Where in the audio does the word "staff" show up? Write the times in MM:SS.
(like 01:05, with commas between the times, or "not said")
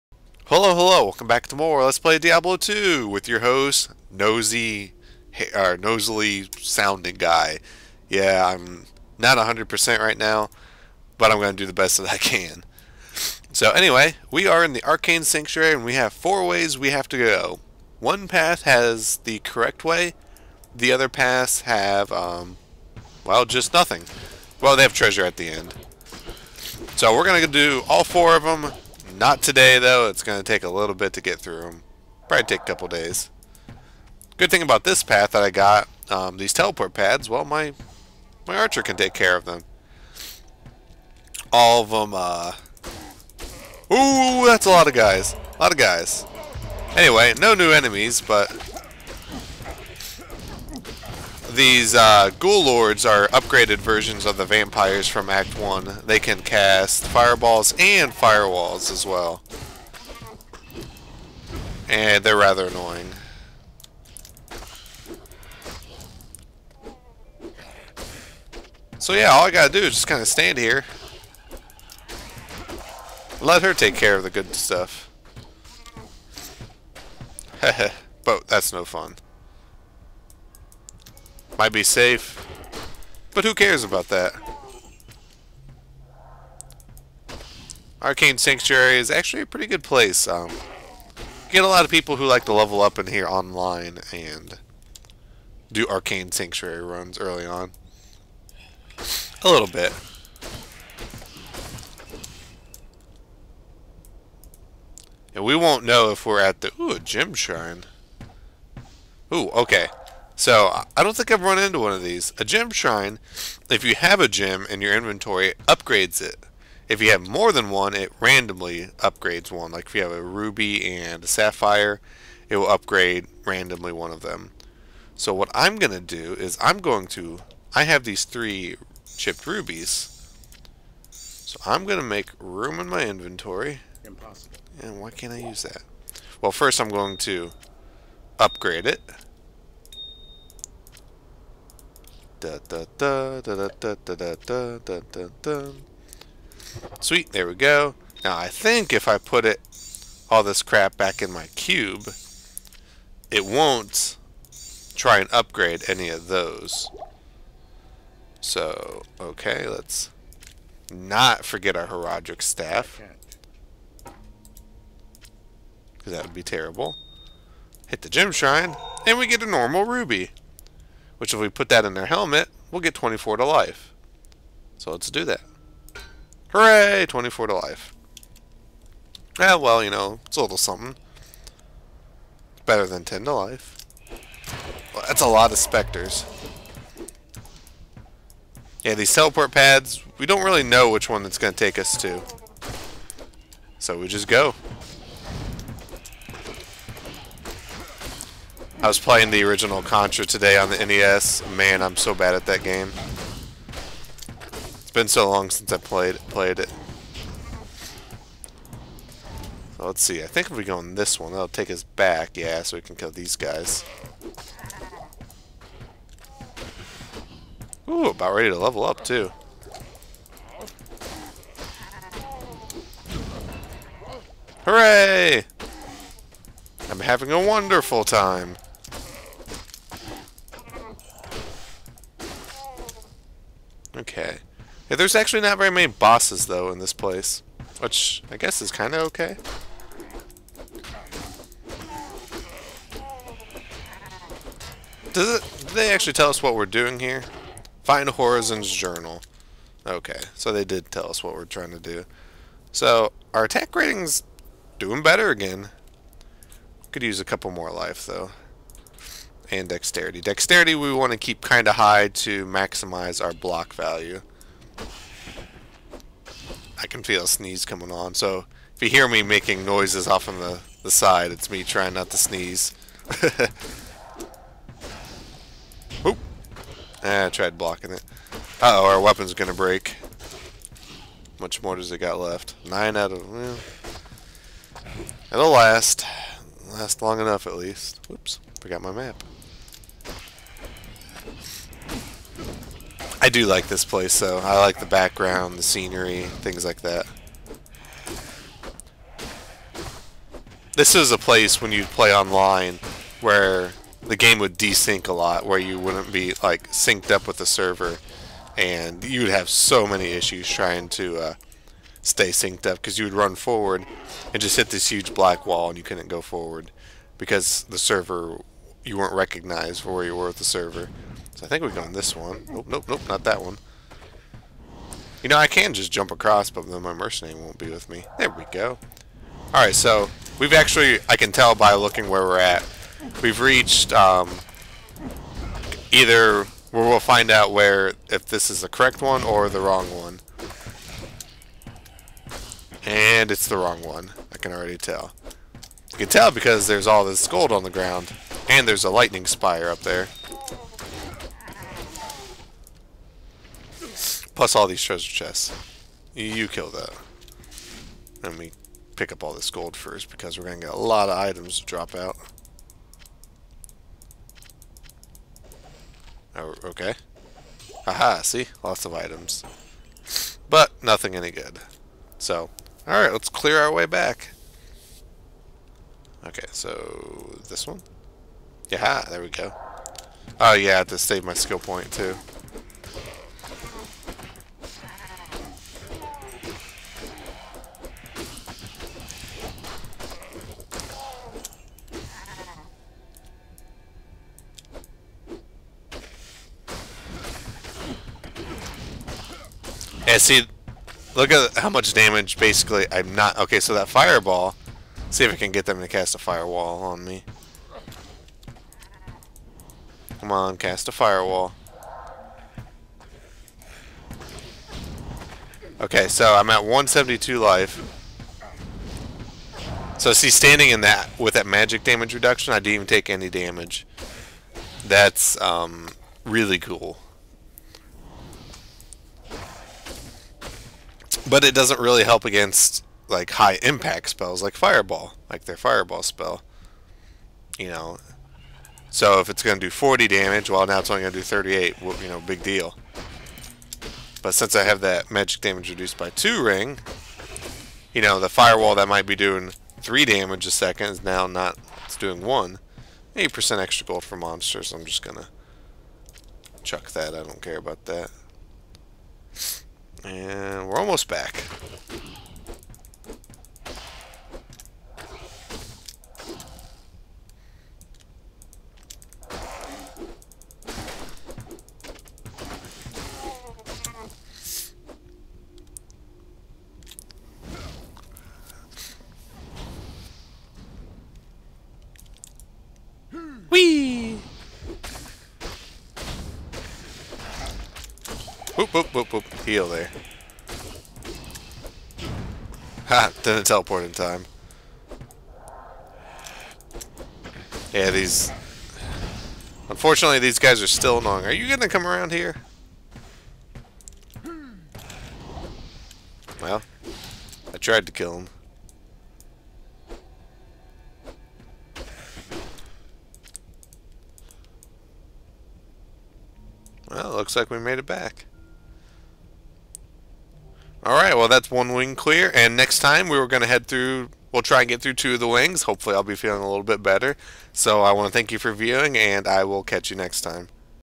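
02:42.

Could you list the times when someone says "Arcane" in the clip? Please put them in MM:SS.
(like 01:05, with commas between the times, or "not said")
00:14, 01:28, 01:35.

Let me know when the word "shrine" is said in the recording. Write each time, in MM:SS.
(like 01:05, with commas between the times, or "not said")
01:47, 01:52, 02:48.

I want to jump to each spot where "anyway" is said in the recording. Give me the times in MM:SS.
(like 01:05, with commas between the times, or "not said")
00:13, 00:46.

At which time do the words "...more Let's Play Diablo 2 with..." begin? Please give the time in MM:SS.
00:01.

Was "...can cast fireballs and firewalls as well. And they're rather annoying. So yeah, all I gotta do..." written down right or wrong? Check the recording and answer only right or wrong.
right.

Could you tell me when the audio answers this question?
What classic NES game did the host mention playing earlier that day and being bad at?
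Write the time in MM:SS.
03:19.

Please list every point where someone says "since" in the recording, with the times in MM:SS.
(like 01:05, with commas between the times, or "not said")
03:25, 07:24.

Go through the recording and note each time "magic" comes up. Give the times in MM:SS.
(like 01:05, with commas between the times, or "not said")
07:01, 07:25.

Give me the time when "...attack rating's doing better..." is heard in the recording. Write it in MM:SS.
04:13.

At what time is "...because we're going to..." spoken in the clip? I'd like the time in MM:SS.
06:00.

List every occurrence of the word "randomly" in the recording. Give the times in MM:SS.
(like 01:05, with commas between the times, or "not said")
01:58, 02:03.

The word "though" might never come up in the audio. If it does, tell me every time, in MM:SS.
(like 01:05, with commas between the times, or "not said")
00:29, 03:56, 04:18, 04:54.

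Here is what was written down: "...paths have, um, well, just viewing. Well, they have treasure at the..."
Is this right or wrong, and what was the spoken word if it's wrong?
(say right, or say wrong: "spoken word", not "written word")
wrong: "nothing", not "viewing".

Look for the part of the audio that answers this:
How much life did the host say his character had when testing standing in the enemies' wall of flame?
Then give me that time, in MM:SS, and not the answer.
06:56.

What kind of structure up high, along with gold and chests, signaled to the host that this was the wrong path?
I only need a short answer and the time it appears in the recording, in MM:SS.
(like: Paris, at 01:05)
lightning spire, at 05:48.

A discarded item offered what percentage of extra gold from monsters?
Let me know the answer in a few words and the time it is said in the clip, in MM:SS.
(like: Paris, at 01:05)
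8%, at 07:33.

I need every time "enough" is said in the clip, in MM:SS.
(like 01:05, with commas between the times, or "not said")
04:47.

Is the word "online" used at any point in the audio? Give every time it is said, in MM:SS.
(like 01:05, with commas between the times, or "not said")
01:33, 05:02.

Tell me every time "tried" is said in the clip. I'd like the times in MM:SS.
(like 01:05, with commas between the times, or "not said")
04:37, 08:27.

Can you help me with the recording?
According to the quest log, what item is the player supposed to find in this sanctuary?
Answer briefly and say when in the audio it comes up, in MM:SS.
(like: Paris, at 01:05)
Horazon's Journal, at 04:08.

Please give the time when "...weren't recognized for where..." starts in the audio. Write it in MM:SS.
05:18.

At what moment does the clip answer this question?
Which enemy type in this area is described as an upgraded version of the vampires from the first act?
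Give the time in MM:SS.
00:52.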